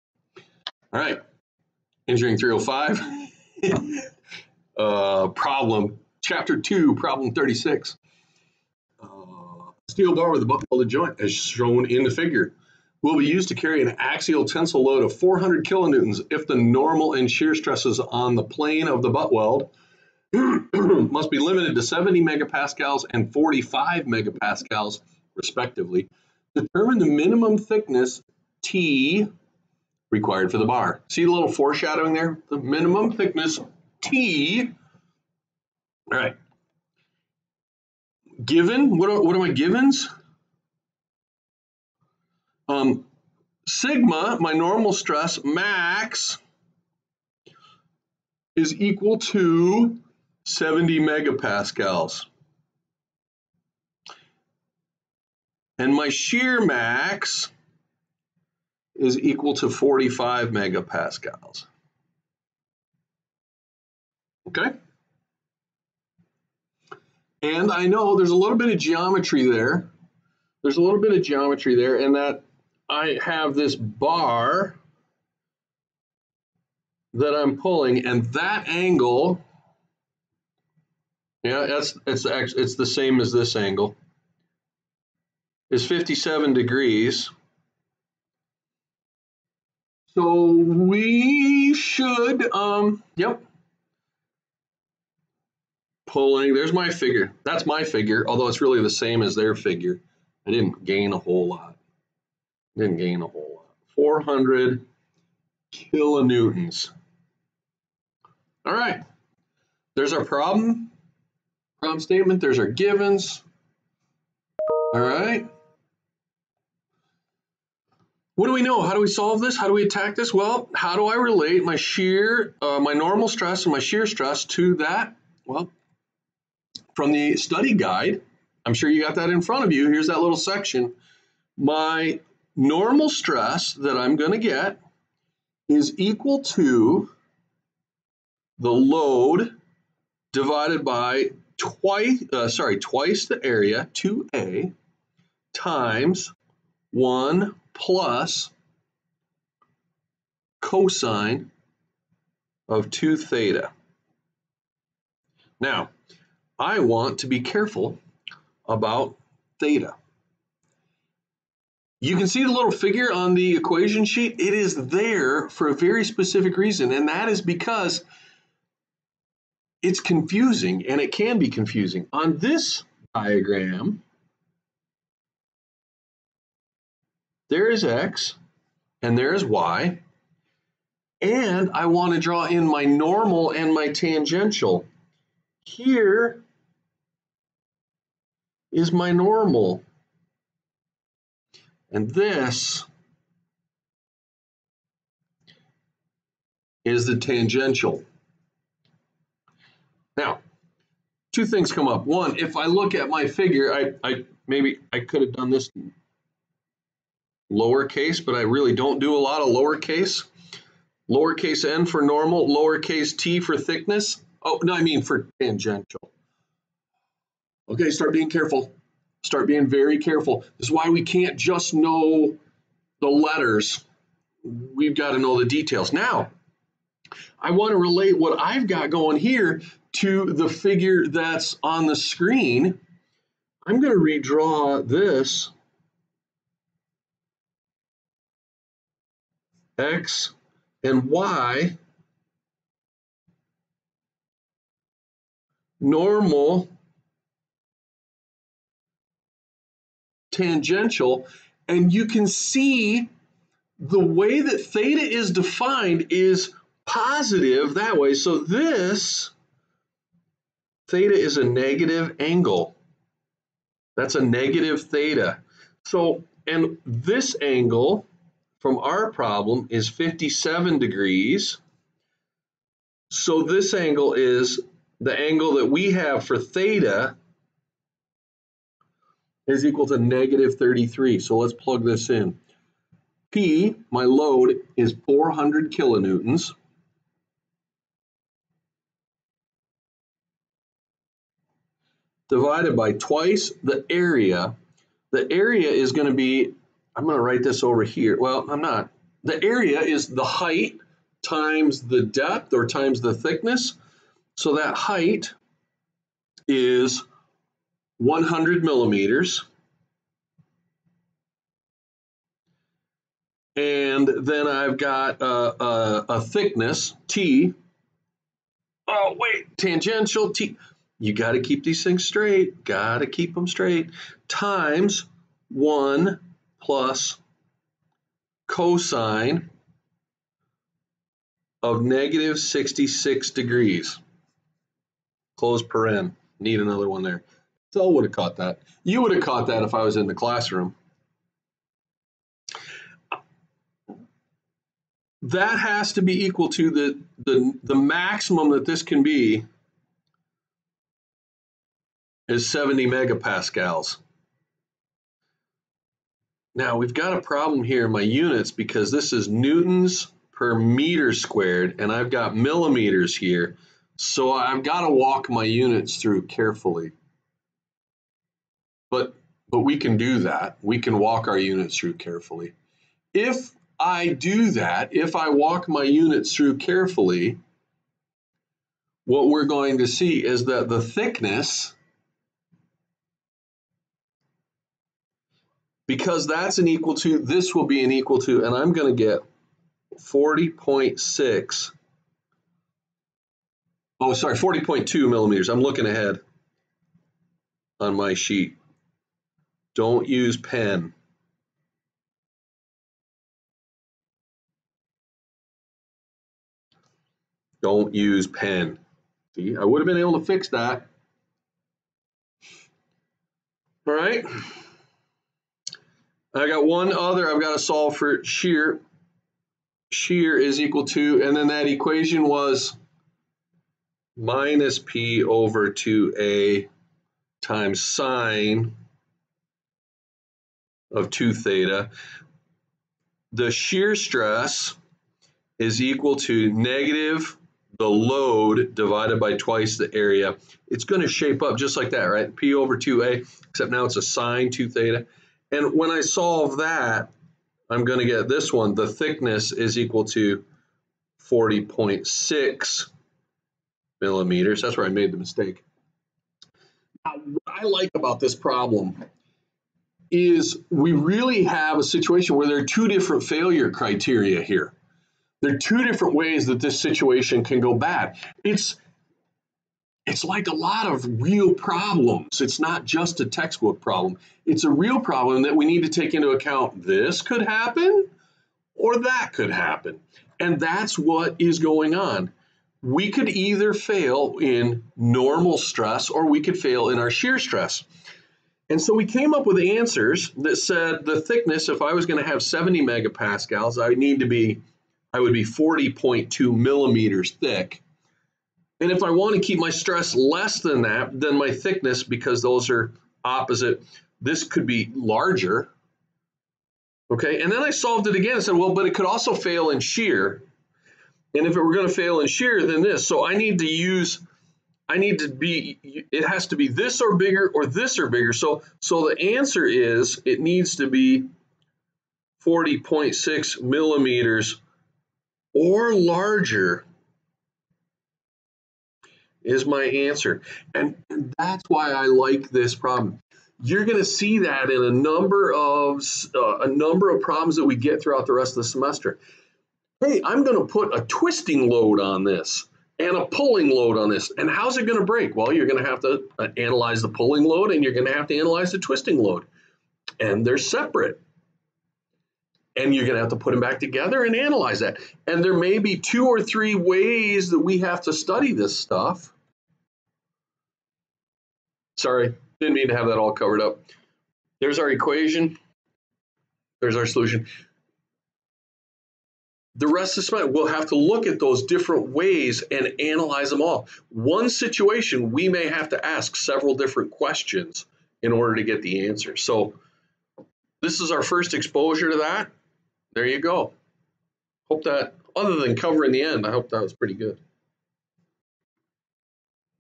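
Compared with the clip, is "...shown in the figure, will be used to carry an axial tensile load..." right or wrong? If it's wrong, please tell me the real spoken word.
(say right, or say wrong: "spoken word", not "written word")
right.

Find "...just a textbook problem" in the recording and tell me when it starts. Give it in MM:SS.
07:52.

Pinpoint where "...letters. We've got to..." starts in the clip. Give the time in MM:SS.
03:43.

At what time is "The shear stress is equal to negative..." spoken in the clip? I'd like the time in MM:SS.
07:13.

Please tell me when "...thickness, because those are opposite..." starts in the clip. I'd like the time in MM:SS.
08:21.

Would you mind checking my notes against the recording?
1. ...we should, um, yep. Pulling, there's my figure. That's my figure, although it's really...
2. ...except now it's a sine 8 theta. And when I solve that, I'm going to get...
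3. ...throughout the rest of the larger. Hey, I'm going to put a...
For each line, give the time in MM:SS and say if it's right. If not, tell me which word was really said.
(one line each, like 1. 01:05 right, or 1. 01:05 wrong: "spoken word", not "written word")
1. 01:30 right
2. 07:23 wrong: "2", not "8"
3. 08:58 wrong: "semester", not "larger".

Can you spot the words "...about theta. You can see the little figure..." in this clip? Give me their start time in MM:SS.
02:38.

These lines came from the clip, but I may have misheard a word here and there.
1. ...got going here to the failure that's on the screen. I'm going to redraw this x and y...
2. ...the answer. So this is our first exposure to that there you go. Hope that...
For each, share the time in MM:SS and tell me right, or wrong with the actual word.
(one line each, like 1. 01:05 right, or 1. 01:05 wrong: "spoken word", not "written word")
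1. 03:48 wrong: "figure", not "failure"
2. 09:38 right.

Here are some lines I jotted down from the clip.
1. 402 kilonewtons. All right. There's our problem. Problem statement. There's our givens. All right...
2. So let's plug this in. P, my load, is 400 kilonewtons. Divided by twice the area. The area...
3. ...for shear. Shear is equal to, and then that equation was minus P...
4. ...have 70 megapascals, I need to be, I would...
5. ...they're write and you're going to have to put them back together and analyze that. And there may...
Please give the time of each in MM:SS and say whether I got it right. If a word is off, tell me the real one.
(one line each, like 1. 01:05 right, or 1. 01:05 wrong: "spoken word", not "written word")
1. 01:43 wrong: "400", not "402"
2. 04:41 right
3. 06:57 right
4. 08:12 right
5. 09:10 wrong: "separate", not "write".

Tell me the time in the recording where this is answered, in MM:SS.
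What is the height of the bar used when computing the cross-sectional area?
05:07.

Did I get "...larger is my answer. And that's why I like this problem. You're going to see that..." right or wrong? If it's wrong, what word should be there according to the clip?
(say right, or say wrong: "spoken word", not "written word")
right.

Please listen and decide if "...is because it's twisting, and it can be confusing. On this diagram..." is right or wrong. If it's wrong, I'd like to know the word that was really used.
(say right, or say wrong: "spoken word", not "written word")
wrong: "confusing", not "twisting".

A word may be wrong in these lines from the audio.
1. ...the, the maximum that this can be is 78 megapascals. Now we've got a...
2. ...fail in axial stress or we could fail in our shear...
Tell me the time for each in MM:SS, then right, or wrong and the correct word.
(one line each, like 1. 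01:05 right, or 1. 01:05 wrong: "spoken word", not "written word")
1. 05:47 wrong: "70", not "78"
2. 08:03 wrong: "normal", not "axial".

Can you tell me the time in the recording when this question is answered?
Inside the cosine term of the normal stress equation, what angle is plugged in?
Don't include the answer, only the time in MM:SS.
05:31.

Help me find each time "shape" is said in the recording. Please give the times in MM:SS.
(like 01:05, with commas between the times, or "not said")
07:21.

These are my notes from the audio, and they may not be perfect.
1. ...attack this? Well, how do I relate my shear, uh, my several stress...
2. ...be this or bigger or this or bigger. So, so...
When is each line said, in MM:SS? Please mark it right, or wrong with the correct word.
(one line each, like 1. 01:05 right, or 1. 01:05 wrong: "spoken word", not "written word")
1. 01:59 wrong: "normal", not "several"
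2. 08:36 right.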